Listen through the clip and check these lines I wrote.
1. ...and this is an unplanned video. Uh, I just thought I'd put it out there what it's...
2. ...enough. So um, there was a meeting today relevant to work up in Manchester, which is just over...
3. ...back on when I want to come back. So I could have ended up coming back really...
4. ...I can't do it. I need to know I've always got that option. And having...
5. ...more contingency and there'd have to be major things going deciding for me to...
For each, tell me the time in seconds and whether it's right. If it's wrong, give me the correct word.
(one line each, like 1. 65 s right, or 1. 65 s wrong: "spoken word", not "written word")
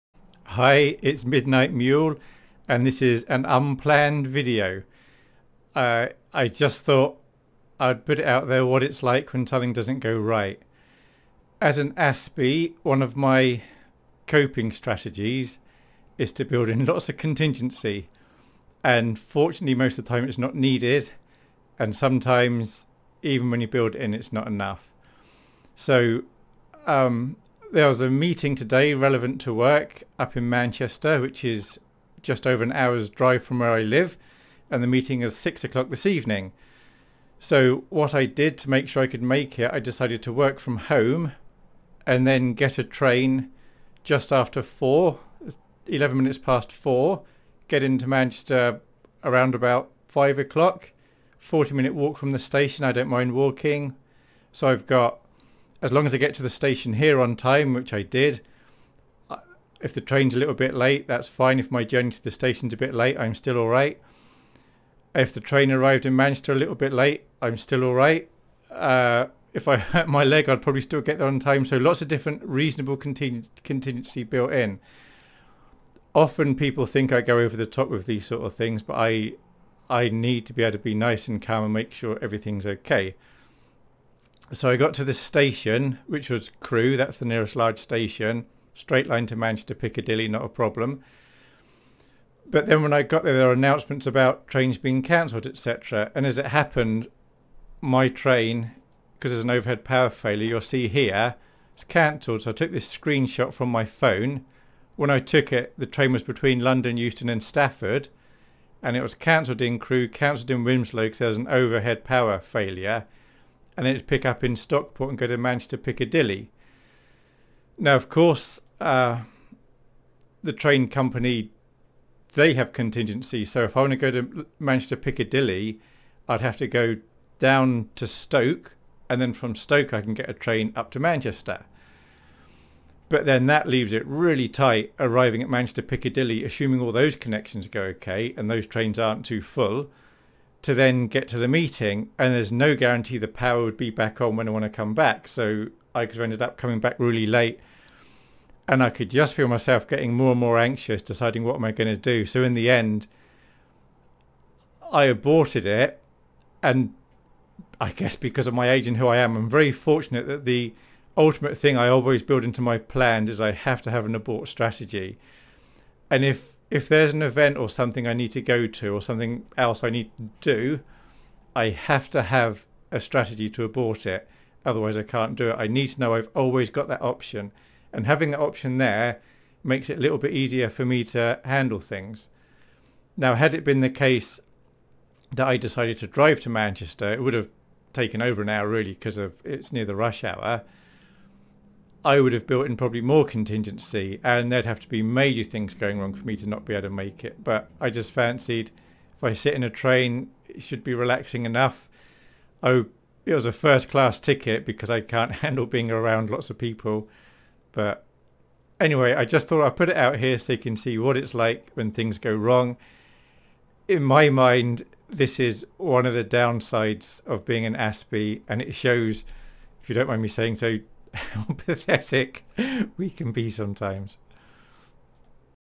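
1. 2 s right
2. 24 s right
3. 143 s right
4. 174 s right
5. 193 s wrong: "wrong", not "deciding".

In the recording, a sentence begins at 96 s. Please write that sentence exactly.
And as it happened, my train, because there's an overhead power failure, you'll see here, it's cancelled.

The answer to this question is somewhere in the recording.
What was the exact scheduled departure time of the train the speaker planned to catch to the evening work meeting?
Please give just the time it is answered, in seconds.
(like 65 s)
45 s.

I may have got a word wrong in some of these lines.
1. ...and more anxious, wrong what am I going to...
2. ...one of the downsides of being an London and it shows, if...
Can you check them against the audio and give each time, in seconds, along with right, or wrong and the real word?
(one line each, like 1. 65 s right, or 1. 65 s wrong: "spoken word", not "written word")
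1. 150 s wrong: "deciding", not "wrong"
2. 215 s wrong: "Aspie", not "London".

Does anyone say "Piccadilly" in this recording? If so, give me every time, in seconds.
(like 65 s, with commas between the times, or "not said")
89 s, 115 s, 124 s, 135 s.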